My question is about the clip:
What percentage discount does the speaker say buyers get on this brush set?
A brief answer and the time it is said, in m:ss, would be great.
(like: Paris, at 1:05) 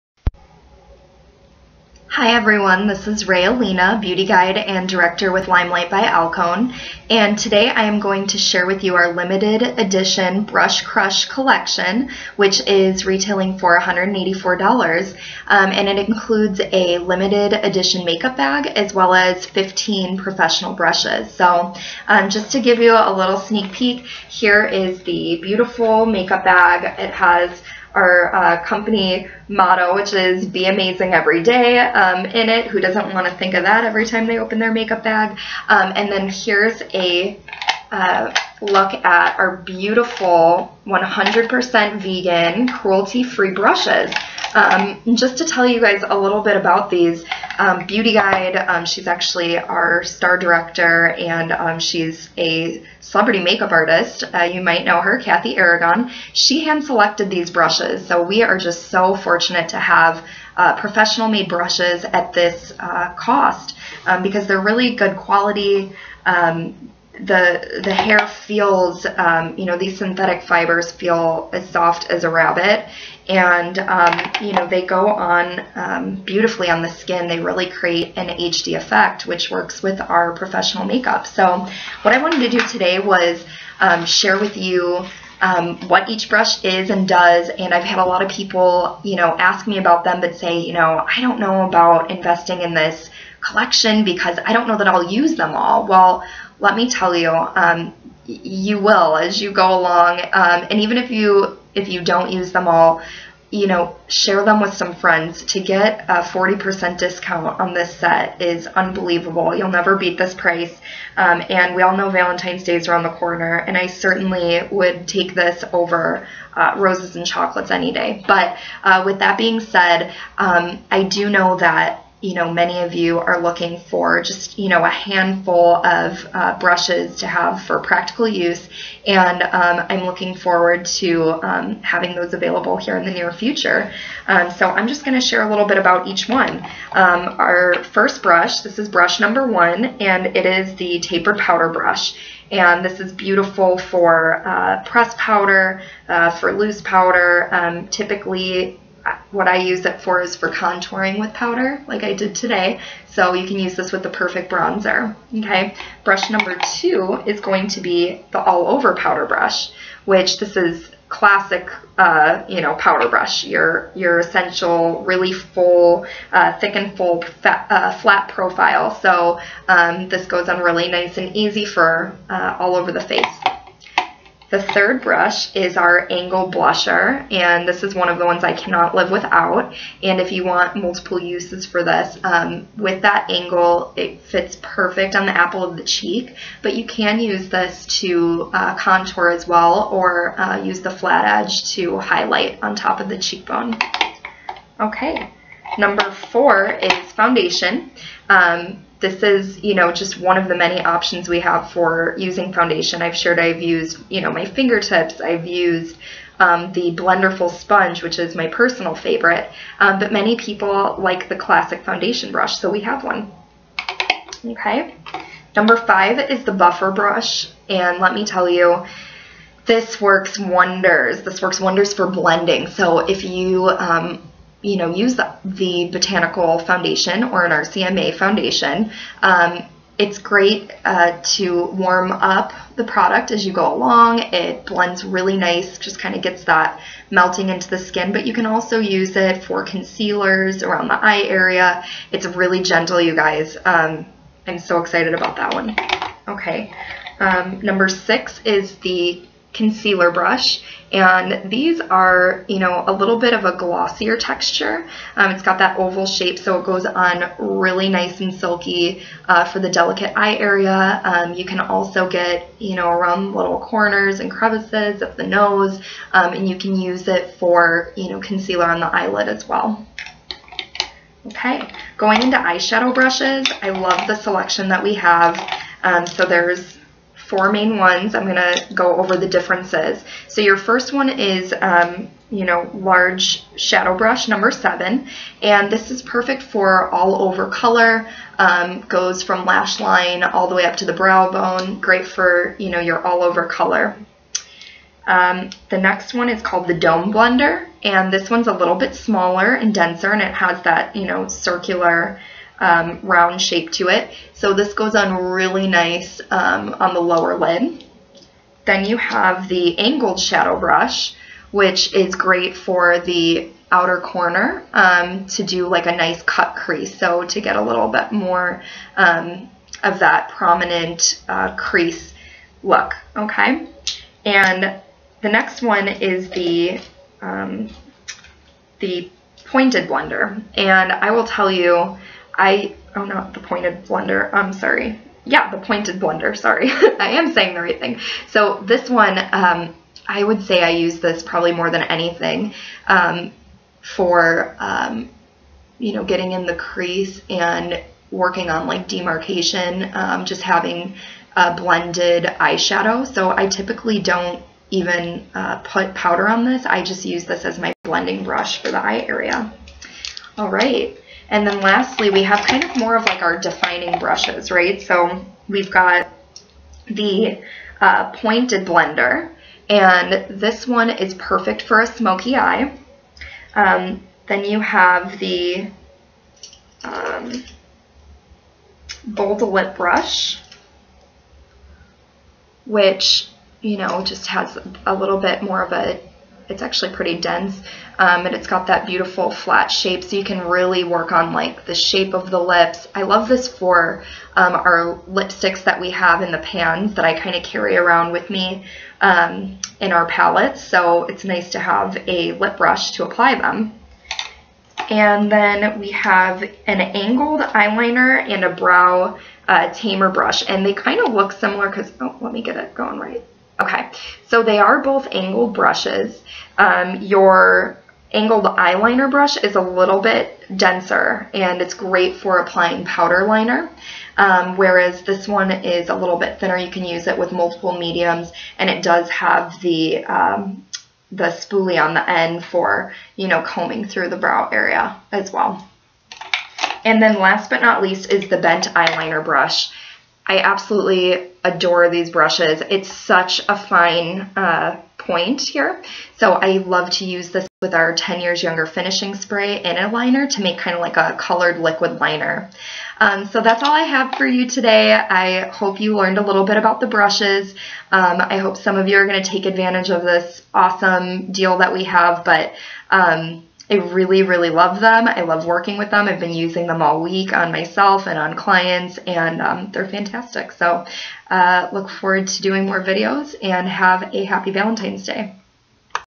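40%, at 1:46.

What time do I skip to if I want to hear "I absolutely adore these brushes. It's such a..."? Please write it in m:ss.
7:20.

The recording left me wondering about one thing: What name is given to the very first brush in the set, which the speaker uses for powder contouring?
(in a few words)
tapered powder brush.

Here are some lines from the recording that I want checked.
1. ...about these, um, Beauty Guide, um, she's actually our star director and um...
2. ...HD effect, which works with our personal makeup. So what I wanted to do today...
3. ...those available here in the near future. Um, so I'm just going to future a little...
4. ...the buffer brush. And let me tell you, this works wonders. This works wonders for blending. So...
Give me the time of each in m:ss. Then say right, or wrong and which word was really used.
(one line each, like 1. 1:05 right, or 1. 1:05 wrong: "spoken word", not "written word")
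1. 0:46 right
2. 1:18 wrong: "professional", not "personal"
3. 2:12 wrong: "share", not "future"
4. 3:36 right.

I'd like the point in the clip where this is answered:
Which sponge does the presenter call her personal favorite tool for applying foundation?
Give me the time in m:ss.
3:26.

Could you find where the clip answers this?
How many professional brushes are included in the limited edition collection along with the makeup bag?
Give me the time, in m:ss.
0:19.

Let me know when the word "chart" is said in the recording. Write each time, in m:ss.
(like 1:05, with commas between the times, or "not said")
not said.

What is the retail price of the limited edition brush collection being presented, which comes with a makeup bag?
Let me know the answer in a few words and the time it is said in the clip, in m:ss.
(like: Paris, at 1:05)
$184, at 0:13.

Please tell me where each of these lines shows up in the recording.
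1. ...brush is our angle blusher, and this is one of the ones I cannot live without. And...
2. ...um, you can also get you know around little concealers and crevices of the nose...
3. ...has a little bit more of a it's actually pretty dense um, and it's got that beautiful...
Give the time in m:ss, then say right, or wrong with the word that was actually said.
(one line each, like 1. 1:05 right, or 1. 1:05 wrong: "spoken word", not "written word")
1. 2:55 right
2. 4:21 wrong: "corners", not "concealers"
3. 6:24 right.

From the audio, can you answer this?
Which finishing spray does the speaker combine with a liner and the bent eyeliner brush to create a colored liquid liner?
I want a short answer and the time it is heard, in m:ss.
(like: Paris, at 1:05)
10 years younger, at 7:27.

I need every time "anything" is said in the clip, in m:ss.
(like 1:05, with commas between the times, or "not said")
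5:41.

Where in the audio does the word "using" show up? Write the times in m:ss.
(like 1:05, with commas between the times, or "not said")
3:22, 7:46.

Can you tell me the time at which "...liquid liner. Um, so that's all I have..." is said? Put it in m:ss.
7:31.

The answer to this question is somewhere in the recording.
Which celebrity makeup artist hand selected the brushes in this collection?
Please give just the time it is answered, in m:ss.
0:55.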